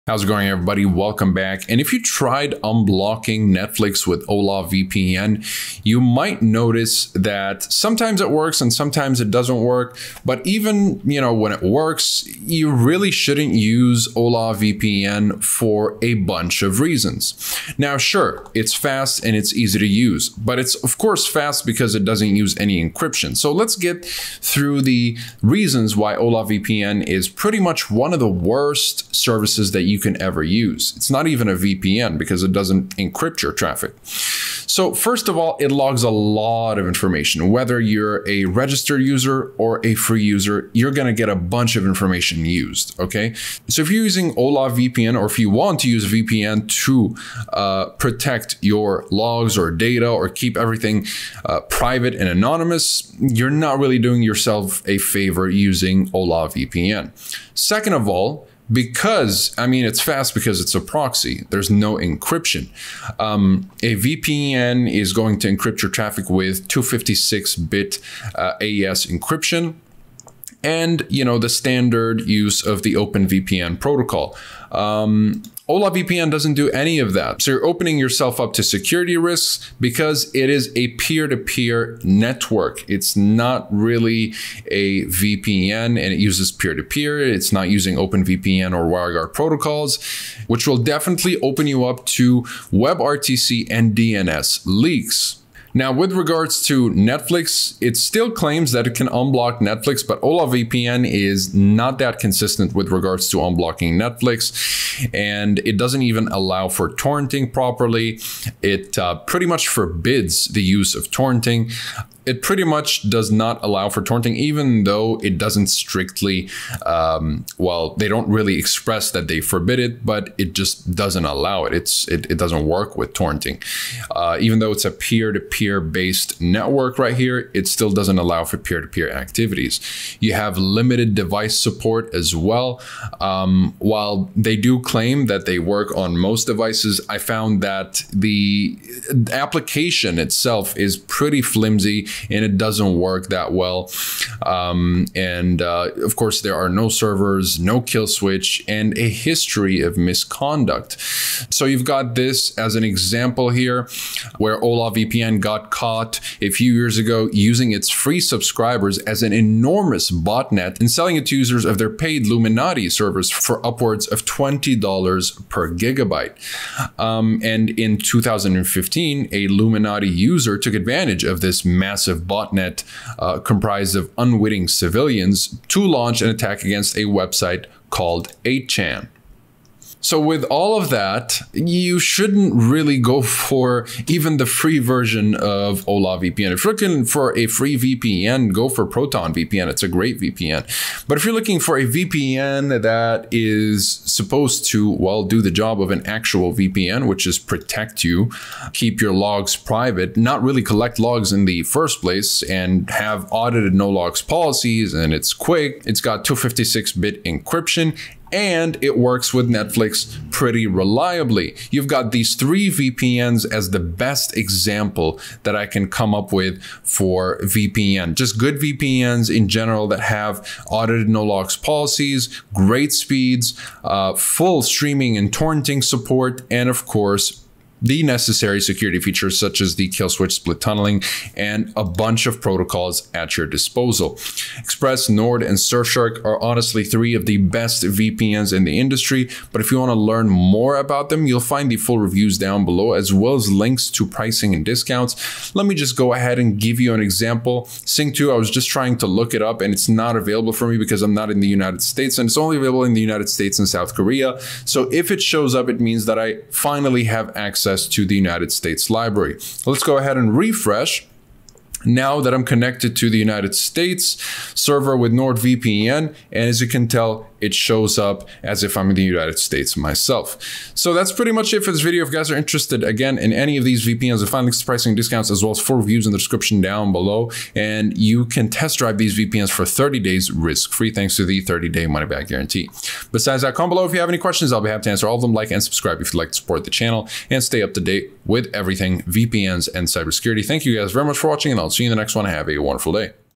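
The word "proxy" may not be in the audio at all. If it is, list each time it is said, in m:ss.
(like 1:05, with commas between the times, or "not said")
1:00.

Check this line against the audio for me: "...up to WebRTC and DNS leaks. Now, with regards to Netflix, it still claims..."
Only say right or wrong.
right.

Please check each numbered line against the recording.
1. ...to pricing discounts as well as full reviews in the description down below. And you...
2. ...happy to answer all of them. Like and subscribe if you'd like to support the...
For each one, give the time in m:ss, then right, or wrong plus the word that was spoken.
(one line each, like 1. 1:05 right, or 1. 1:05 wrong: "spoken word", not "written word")
1. 4:34 right
2. 4:44 right.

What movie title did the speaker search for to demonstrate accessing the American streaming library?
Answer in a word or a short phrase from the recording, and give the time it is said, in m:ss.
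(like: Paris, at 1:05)
Sing 2, at 4:07.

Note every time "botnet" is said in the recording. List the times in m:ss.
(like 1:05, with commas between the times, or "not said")
2:40, 2:52.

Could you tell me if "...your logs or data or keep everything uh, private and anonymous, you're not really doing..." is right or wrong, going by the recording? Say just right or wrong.
right.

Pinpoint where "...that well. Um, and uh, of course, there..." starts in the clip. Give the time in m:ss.
2:23.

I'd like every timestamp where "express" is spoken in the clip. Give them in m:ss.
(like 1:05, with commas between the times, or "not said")
1:58, 3:54.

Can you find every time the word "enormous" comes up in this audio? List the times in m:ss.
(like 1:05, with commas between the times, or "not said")
2:39.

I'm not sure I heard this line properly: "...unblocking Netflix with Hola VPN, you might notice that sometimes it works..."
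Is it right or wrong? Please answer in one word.
right.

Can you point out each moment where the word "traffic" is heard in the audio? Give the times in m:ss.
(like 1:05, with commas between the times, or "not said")
0:33, 1:05.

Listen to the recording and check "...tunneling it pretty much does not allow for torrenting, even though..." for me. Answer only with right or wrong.
wrong.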